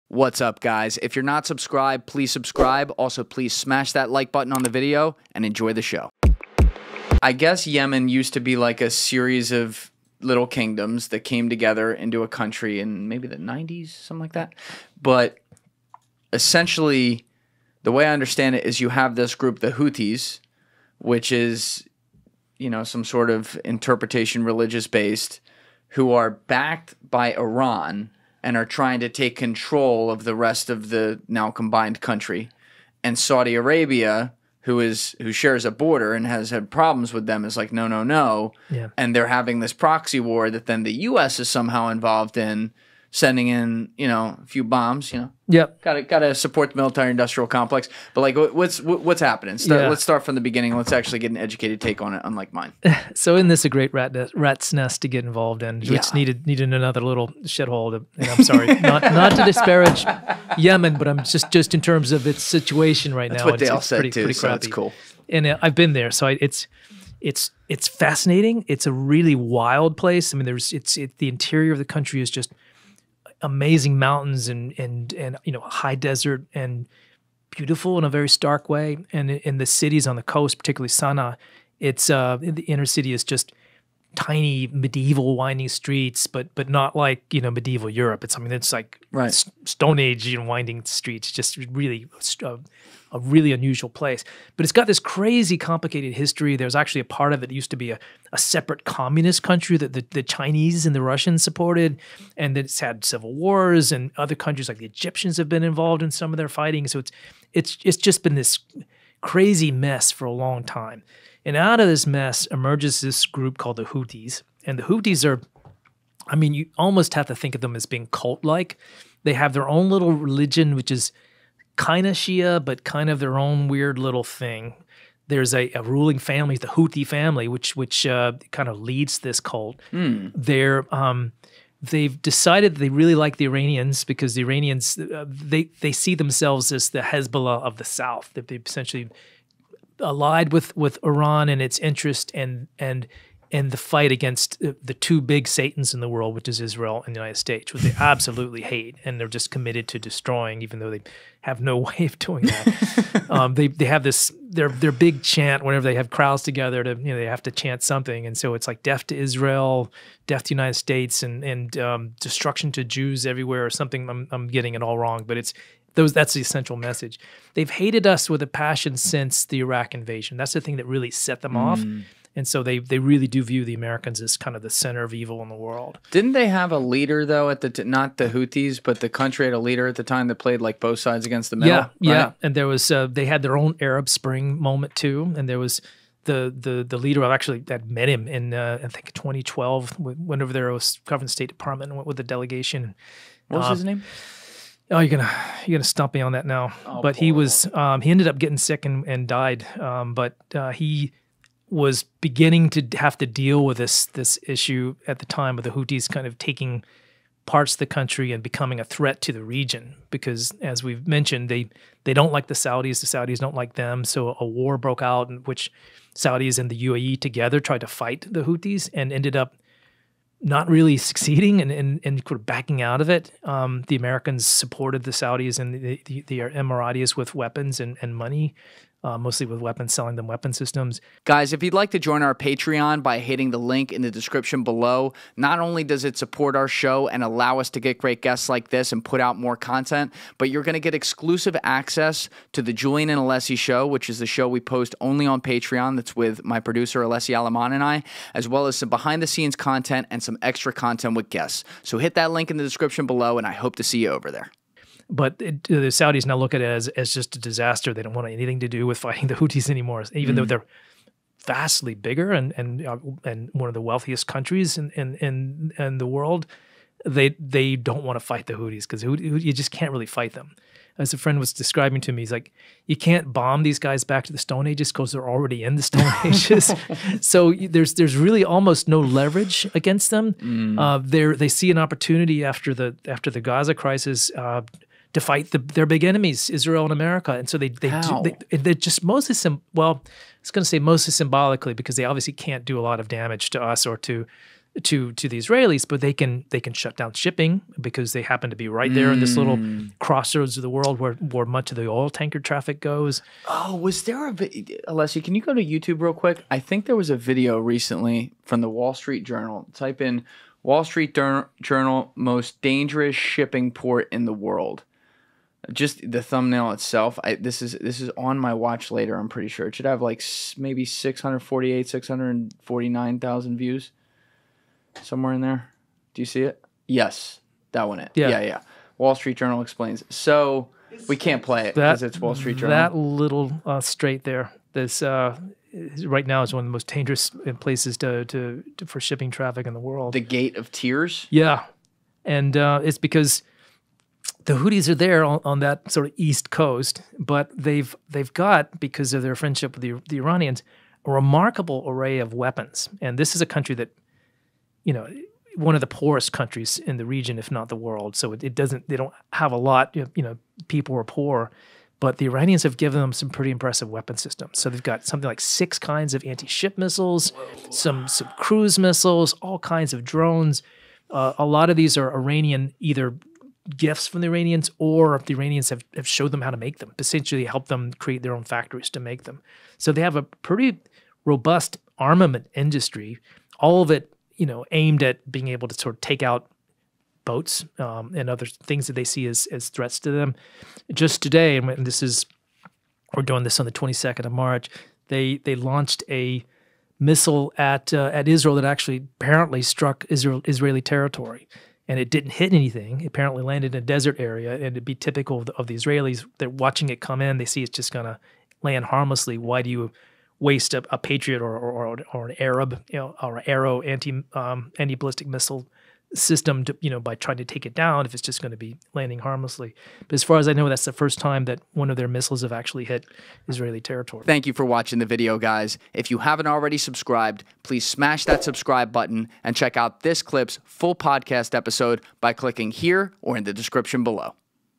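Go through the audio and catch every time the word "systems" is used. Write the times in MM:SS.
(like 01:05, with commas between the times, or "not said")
03:50, 06:04, 06:56.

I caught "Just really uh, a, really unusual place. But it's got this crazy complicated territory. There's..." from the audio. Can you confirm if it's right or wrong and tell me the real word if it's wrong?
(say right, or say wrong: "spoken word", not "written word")
wrong: "history", not "territory".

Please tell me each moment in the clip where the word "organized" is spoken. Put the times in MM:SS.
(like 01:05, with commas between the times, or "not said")
not said.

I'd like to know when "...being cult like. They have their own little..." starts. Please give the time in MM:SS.
01:57.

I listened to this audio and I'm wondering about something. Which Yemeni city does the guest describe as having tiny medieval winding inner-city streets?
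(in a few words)
Sana'a.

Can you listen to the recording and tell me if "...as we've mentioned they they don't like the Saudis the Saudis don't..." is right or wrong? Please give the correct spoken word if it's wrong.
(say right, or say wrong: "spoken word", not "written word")
right.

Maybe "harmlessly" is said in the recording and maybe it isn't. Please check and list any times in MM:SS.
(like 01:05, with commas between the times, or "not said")
06:48, 06:59.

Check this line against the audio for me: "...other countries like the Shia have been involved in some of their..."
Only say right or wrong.
wrong.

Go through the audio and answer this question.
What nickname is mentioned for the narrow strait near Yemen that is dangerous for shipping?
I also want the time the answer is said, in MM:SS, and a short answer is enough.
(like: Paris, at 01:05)
the gate of tears, at 05:40.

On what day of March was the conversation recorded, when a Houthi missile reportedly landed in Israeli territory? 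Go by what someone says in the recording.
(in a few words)
22nd.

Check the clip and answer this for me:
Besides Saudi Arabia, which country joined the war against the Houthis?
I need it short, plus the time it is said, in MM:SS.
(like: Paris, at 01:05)
UAE, at 03:36.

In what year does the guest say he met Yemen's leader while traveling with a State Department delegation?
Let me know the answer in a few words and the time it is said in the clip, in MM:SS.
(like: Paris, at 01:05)
2012, at 03:09.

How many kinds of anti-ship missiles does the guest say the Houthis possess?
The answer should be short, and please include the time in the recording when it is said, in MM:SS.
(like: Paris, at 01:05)
6, at 06:05.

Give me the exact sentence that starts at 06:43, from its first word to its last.
It apparently landed in a desert area, and it'd be typical of the, of the Israelis.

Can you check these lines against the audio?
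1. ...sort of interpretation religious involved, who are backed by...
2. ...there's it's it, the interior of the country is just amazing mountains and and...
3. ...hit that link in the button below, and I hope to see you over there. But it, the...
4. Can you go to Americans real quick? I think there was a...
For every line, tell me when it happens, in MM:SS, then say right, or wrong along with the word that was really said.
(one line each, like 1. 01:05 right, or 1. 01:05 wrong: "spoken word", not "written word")
1. 00:23 wrong: "based", not "involved"
2. 01:10 right
3. 04:11 wrong: "description", not "button"
4. 05:05 wrong: "YouTube", not "Americans".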